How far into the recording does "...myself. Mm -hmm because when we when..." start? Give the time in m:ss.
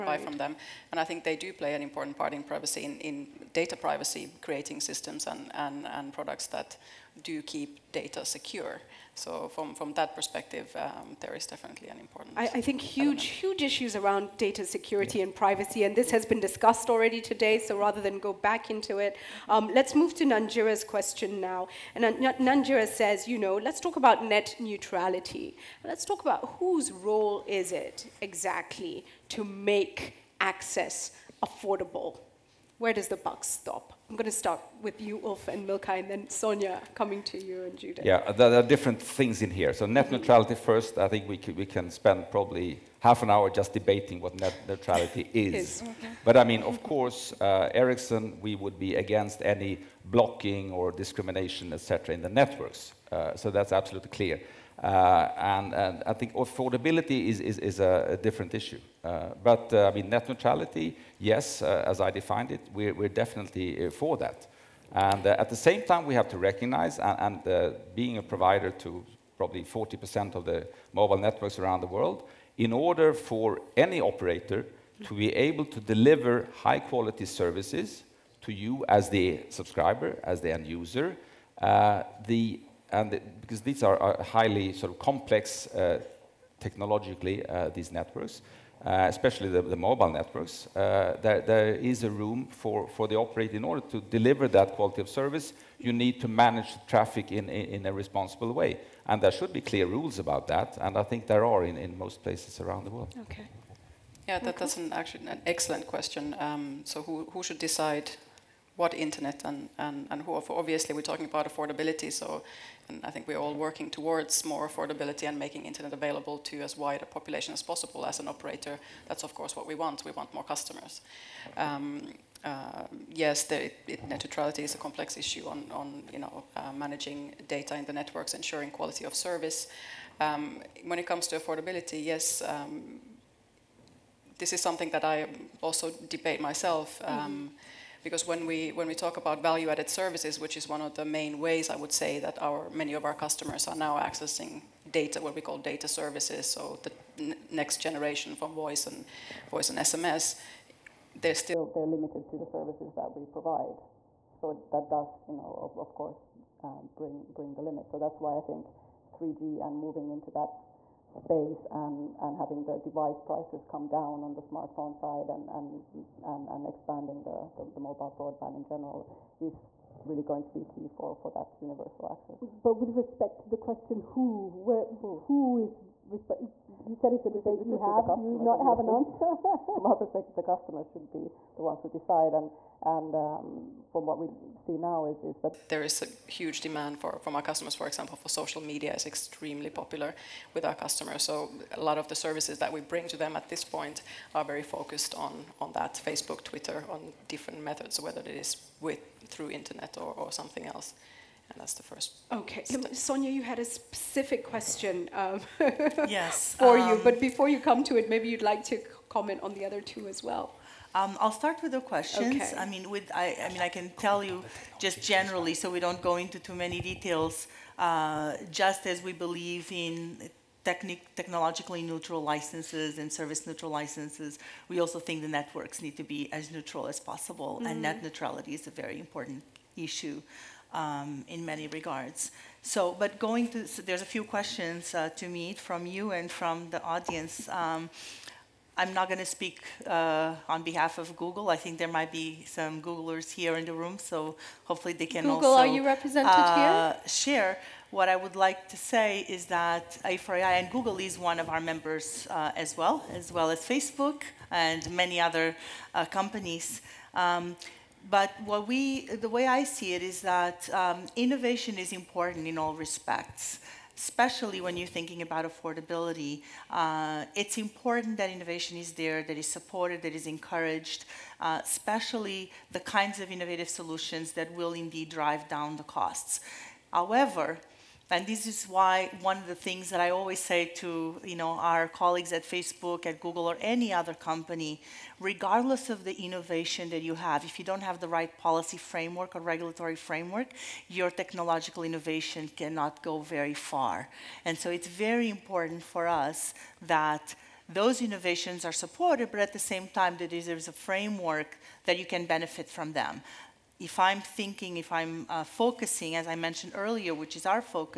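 2:16.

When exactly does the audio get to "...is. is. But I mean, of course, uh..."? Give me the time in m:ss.
0:45.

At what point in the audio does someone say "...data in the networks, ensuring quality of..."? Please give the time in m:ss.
2:07.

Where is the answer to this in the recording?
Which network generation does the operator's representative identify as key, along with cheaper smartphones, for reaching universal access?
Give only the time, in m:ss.
2:39.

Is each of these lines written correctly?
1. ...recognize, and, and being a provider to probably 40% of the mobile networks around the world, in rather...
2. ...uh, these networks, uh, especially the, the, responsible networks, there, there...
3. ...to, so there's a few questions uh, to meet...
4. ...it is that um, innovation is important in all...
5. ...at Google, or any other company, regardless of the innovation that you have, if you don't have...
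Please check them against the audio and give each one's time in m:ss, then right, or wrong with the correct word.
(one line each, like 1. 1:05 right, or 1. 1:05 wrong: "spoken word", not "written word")
1. 1:06 wrong: "order", not "rather"
2. 1:27 wrong: "mobile", not "responsible"
3. 3:53 right
4. 4:19 right
5. 4:43 right.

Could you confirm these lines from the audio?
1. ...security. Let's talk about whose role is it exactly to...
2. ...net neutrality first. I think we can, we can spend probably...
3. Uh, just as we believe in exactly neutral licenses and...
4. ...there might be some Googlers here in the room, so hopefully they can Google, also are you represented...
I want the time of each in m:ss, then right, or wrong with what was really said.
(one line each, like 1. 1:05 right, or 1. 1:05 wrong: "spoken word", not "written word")
1. 0:24 wrong: "neutrality", not "security"
2. 0:39 right
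3. 3:37 wrong: "technologically", not "exactly"
4. 4:01 right.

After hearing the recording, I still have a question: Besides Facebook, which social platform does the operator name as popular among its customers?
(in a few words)
Twitter.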